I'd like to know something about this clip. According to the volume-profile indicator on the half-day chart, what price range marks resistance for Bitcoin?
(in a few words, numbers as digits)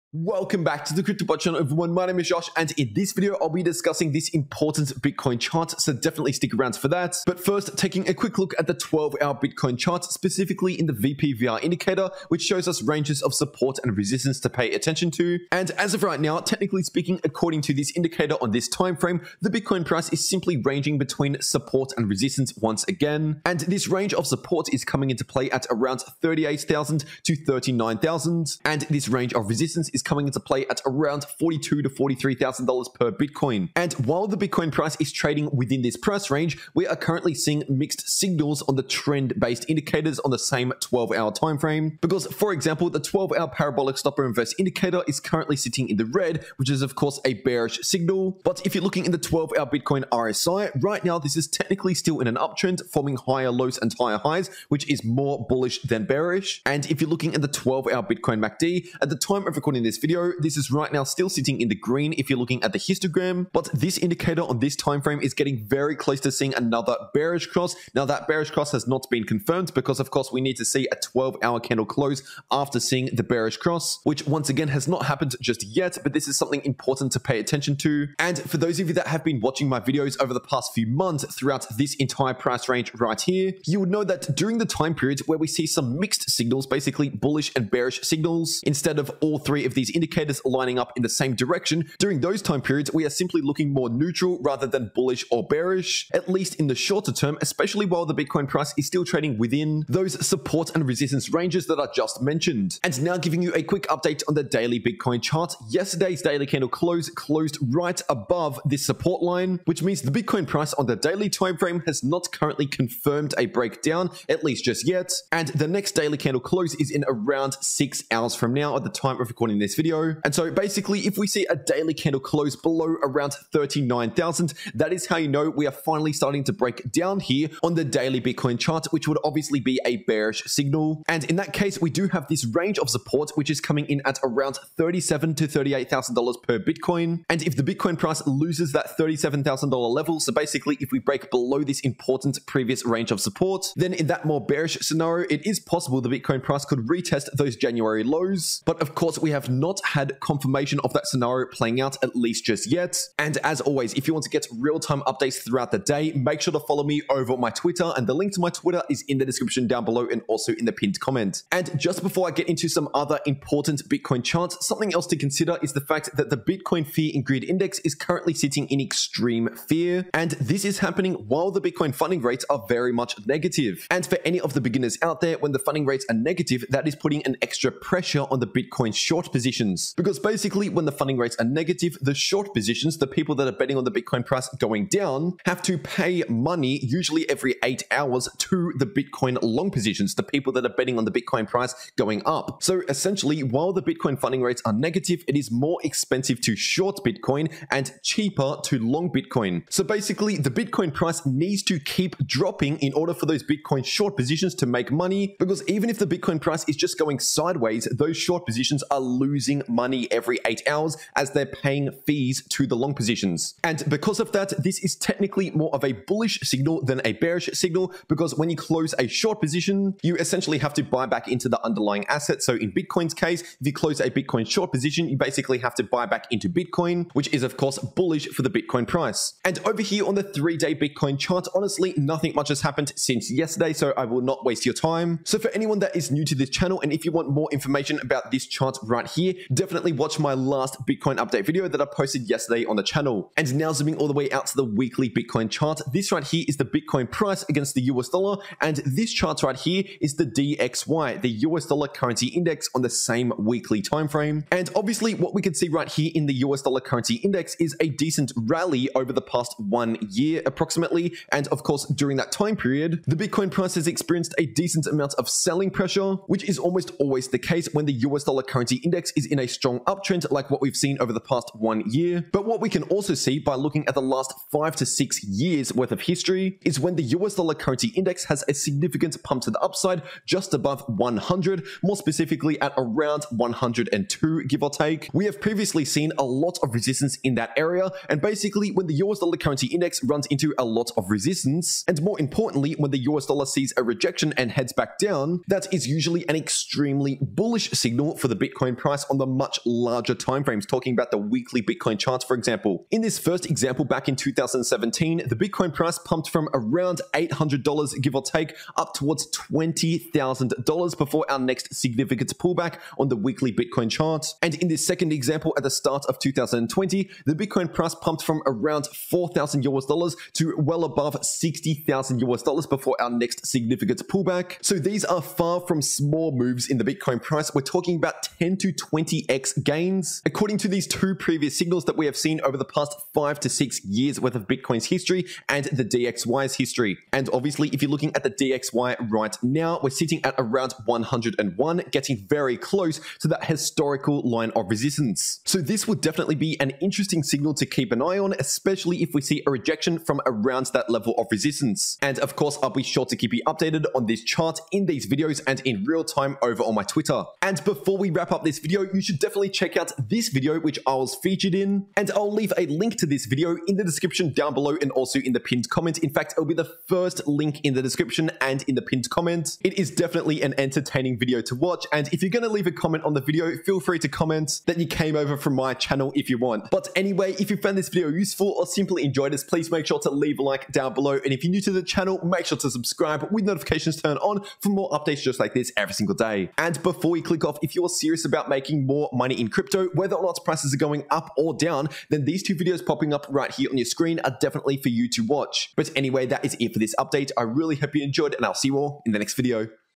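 $42,000 to $43,000.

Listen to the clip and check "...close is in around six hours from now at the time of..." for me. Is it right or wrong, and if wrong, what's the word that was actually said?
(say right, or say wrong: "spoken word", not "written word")
right.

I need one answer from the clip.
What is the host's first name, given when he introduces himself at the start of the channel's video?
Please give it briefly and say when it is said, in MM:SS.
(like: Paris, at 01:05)
Josh, at 00:02.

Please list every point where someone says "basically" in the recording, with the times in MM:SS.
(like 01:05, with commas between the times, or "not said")
01:26, 02:00, 02:20, 03:00, 03:19, 03:45, 04:48.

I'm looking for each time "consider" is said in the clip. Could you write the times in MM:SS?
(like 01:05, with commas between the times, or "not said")
02:45.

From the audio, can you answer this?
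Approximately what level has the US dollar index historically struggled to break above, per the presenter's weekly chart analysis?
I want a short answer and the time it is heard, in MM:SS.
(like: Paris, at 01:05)
102, at 04:43.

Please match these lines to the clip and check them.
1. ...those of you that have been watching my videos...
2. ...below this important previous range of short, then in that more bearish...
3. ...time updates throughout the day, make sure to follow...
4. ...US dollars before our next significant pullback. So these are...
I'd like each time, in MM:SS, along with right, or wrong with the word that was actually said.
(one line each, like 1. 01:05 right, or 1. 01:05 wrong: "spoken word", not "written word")
1. 01:18 right
2. 02:21 wrong: "support", not "short"
3. 02:34 right
4. 05:22 right.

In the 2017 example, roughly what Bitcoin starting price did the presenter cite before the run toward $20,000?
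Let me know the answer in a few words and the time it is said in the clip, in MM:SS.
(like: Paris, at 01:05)
$800, at 05:07.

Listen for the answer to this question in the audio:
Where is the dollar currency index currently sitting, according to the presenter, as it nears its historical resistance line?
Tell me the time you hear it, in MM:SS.
05:40.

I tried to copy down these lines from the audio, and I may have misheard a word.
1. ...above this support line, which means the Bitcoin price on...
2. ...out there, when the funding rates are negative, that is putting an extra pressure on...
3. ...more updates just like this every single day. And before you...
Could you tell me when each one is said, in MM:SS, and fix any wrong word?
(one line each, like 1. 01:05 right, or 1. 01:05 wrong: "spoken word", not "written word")
1. 01:48 right
2. 02:55 right
3. 06:24 right.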